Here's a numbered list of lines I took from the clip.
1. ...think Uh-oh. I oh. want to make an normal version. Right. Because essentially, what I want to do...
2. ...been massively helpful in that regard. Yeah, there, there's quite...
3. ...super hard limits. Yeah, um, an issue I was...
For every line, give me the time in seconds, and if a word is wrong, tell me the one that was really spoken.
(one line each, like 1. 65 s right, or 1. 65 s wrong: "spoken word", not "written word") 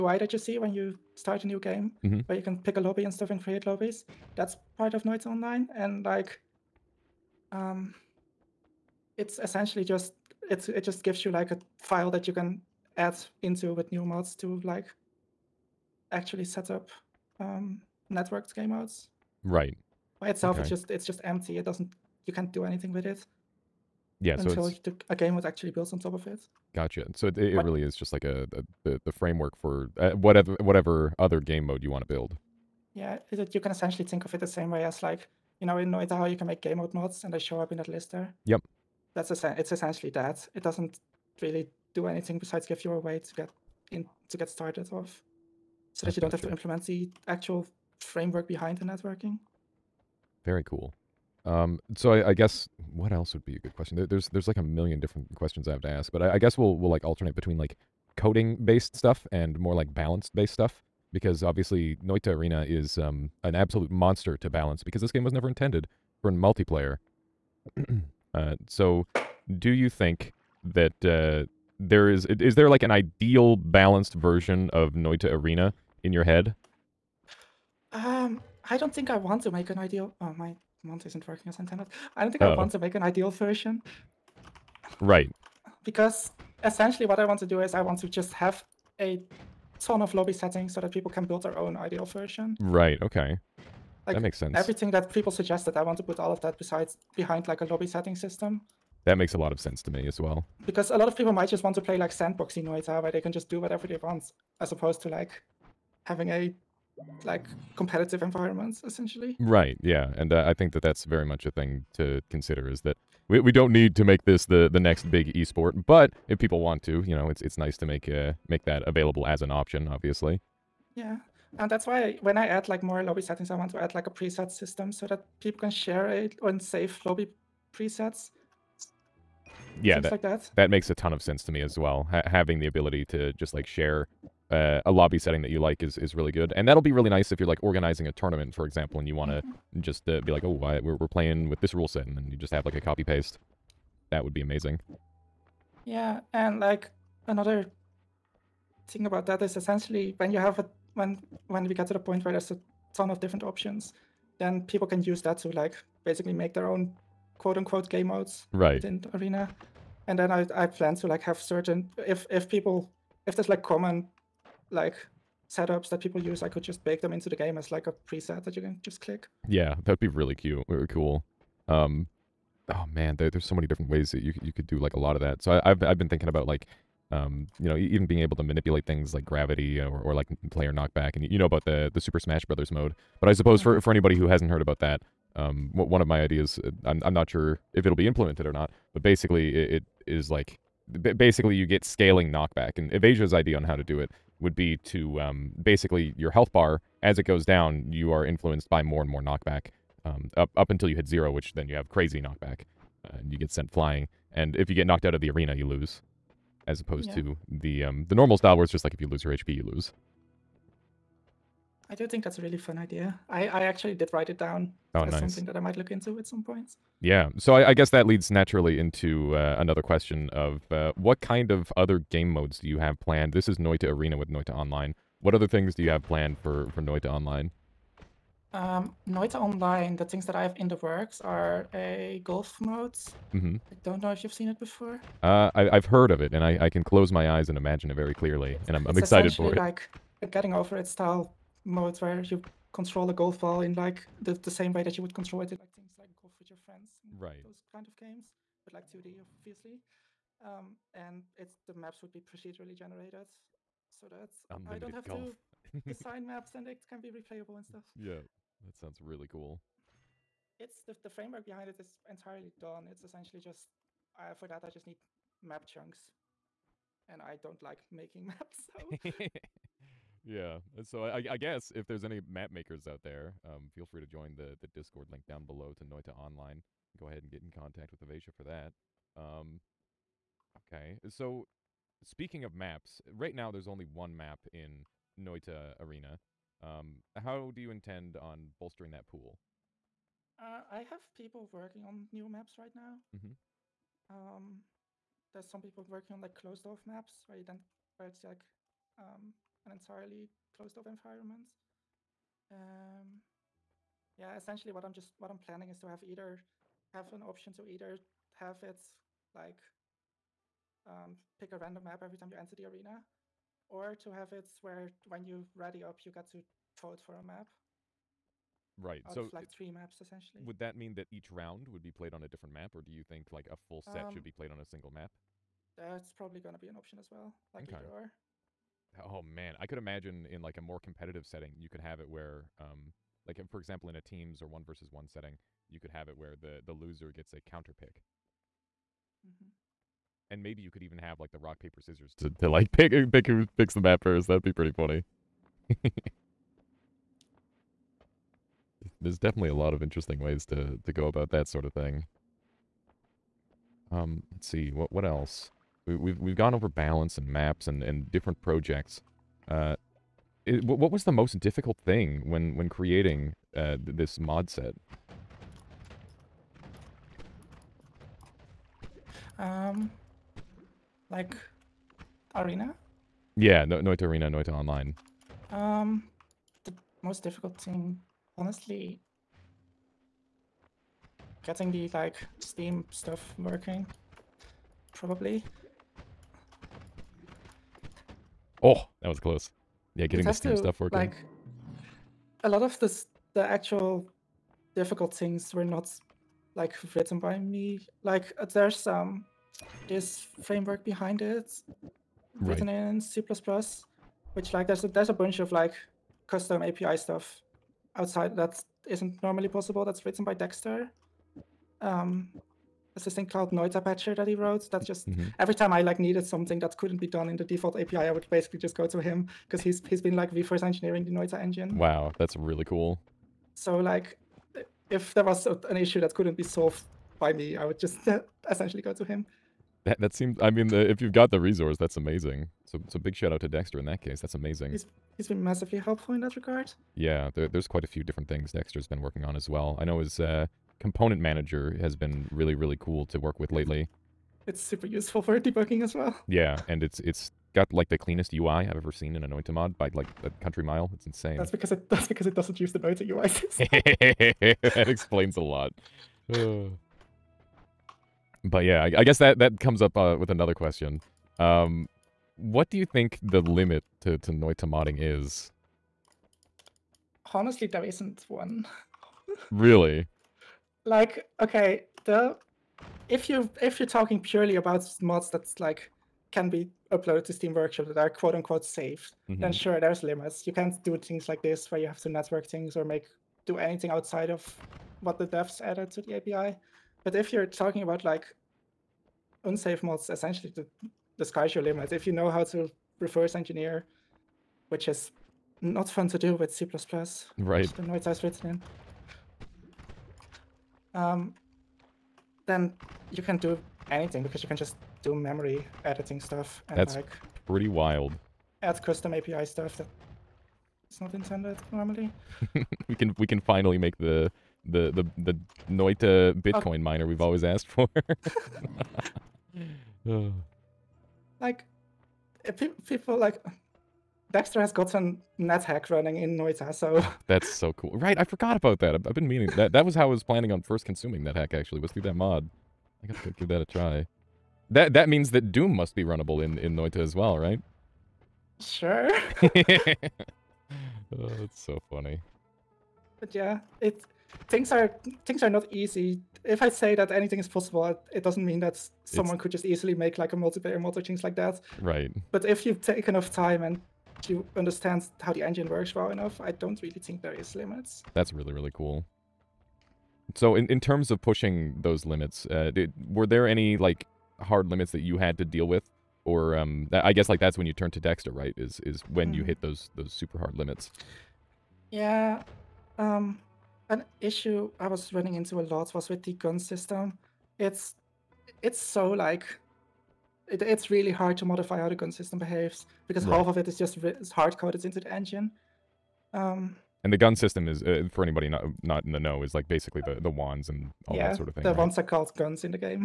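1. 82 s wrong: "ideal", not "normal"
2. 435 s right
3. 570 s right.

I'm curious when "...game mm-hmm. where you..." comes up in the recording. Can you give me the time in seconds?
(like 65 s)
1 s.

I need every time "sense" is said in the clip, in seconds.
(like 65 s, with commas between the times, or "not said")
94 s, 99 s, 131 s.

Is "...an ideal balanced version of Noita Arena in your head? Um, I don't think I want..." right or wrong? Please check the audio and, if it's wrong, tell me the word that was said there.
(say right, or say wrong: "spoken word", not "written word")
right.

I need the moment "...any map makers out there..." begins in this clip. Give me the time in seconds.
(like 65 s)
272 s.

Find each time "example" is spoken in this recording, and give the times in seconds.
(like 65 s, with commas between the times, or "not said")
138 s, 333 s.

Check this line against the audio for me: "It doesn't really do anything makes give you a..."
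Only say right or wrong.
wrong.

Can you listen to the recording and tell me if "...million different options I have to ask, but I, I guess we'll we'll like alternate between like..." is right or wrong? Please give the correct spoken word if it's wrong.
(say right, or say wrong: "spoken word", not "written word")
wrong: "questions", not "options".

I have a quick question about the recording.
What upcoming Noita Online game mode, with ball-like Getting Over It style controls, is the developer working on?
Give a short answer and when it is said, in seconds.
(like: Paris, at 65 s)
Golf mode, at 231 s.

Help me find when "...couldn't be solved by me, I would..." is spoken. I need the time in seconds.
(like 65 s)
426 s.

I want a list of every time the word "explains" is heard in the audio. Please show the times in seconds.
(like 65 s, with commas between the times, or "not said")
454 s.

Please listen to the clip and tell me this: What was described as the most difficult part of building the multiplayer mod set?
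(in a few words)
Steam stuff.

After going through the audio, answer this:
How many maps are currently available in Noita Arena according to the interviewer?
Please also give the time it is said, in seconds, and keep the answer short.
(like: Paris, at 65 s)
1, at 283 s.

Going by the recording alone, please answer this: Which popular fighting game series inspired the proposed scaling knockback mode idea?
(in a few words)
Super Smash Brothers.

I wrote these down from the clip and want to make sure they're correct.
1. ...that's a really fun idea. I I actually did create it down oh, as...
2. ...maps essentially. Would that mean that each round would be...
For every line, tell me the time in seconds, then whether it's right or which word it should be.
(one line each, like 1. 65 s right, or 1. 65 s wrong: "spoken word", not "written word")
1. 212 s wrong: "write", not "create"
2. 319 s right.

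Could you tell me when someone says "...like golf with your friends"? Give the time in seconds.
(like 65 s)
245 s.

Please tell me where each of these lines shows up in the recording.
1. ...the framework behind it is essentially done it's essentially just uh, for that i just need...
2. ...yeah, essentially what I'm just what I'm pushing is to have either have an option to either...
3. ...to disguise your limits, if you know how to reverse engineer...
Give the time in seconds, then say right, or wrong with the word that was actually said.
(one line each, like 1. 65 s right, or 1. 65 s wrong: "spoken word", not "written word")
1. 261 s wrong: "entirely", not "essentially"
2. 304 s wrong: "planning", not "pushing"
3. 490 s right.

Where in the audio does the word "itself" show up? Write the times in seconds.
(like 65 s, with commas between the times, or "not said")
20 s.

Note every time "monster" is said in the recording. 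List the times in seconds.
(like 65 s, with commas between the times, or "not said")
63 s.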